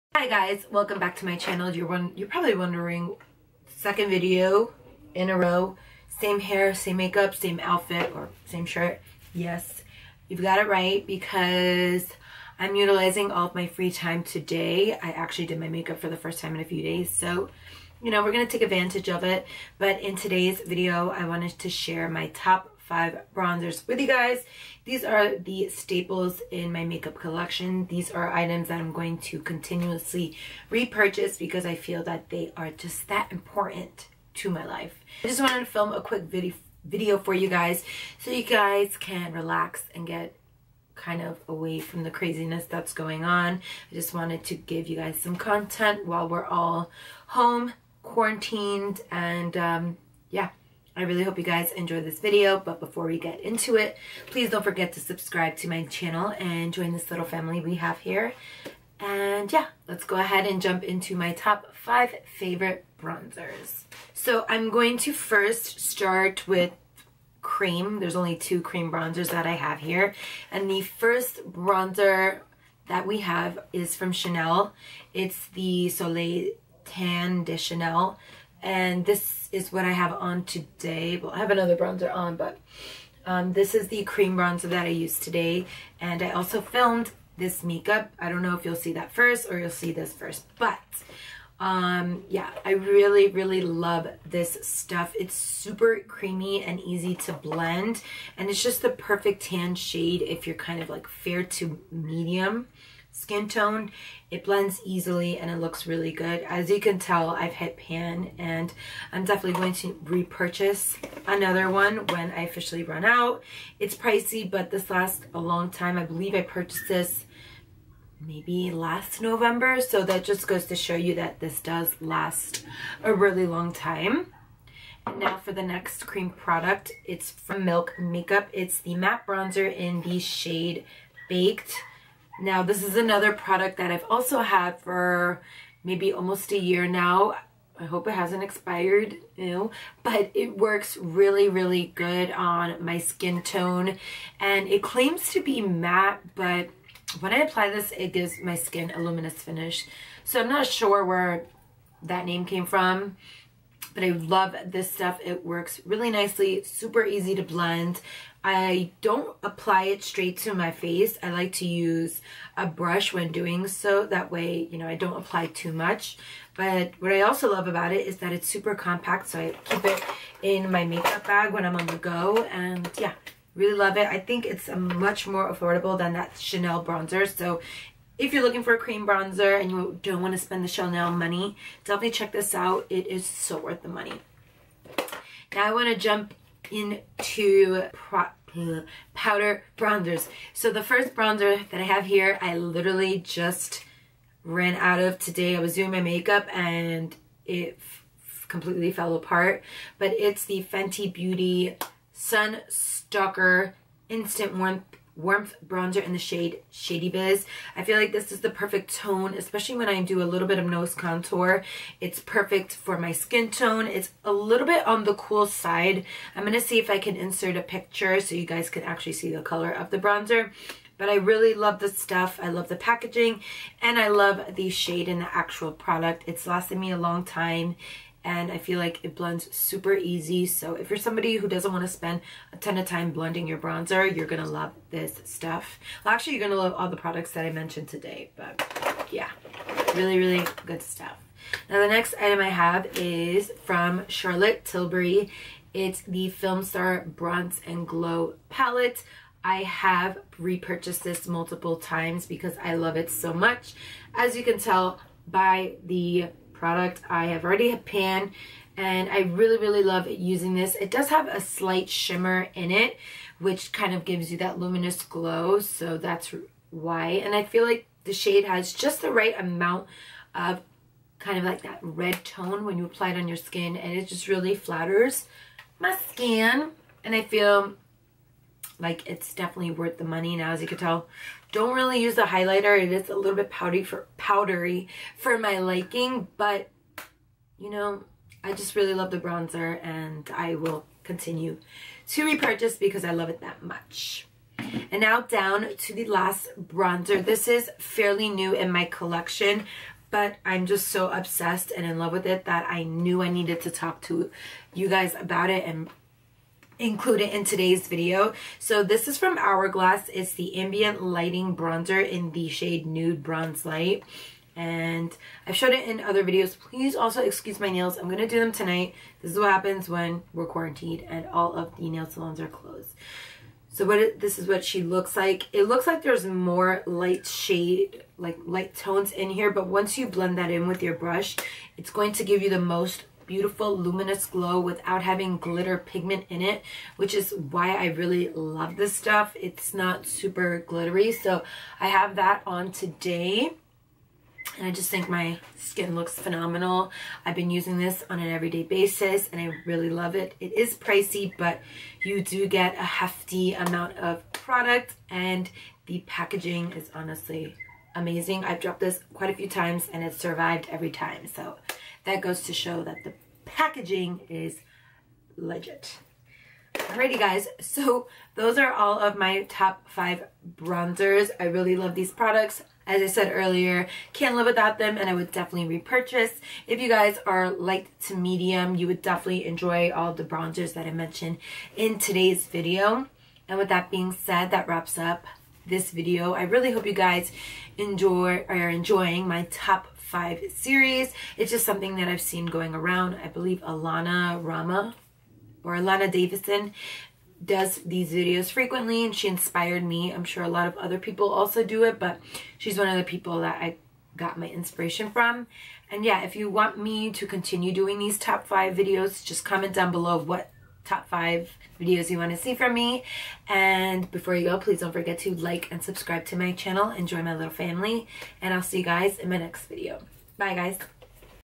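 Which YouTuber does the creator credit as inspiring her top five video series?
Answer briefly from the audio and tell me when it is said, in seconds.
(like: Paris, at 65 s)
Alana Davison, at 395 s.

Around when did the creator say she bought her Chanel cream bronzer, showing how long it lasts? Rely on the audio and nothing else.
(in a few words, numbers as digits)
last November.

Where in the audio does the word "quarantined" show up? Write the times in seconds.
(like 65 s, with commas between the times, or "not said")
48 s, 320 s.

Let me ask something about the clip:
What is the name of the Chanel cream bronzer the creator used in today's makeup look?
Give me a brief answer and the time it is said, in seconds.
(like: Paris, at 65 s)
Soleil Tan de Chanel, at 75 s.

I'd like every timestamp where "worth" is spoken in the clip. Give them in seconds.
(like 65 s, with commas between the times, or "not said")
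183 s, 279 s.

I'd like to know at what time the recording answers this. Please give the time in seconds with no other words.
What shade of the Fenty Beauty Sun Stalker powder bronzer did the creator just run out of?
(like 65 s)
206 s.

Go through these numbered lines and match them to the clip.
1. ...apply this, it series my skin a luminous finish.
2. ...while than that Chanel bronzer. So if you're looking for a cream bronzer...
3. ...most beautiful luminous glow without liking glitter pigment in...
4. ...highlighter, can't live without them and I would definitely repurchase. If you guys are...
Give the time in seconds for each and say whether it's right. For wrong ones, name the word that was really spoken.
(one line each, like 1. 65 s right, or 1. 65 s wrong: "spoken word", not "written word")
1. 147 s wrong: "gives", not "series"
2. 175 s wrong: "affordable", not "while"
3. 332 s wrong: "having", not "liking"
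4. 373 s wrong: "earlier", not "highlighter".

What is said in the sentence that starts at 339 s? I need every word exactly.
It's not super glittery, so I have that on today.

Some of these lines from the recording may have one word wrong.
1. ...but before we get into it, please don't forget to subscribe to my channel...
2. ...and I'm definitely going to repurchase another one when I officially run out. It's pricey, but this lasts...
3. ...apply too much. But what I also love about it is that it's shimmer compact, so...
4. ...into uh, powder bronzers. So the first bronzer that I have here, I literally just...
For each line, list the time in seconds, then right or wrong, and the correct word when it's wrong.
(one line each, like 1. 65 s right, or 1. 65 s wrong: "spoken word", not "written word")
1. 52 s right
2. 108 s right
3. 165 s wrong: "super", not "shimmer"
4. 186 s right.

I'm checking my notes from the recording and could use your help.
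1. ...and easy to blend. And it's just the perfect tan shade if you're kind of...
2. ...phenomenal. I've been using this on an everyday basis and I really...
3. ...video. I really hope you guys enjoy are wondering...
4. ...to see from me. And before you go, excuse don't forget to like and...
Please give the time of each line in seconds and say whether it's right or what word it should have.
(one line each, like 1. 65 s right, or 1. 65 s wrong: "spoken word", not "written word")
1. 96 s right
2. 346 s right
3. 385 s wrong: "enjoying", not "wondering"
4. 412 s wrong: "please", not "excuse".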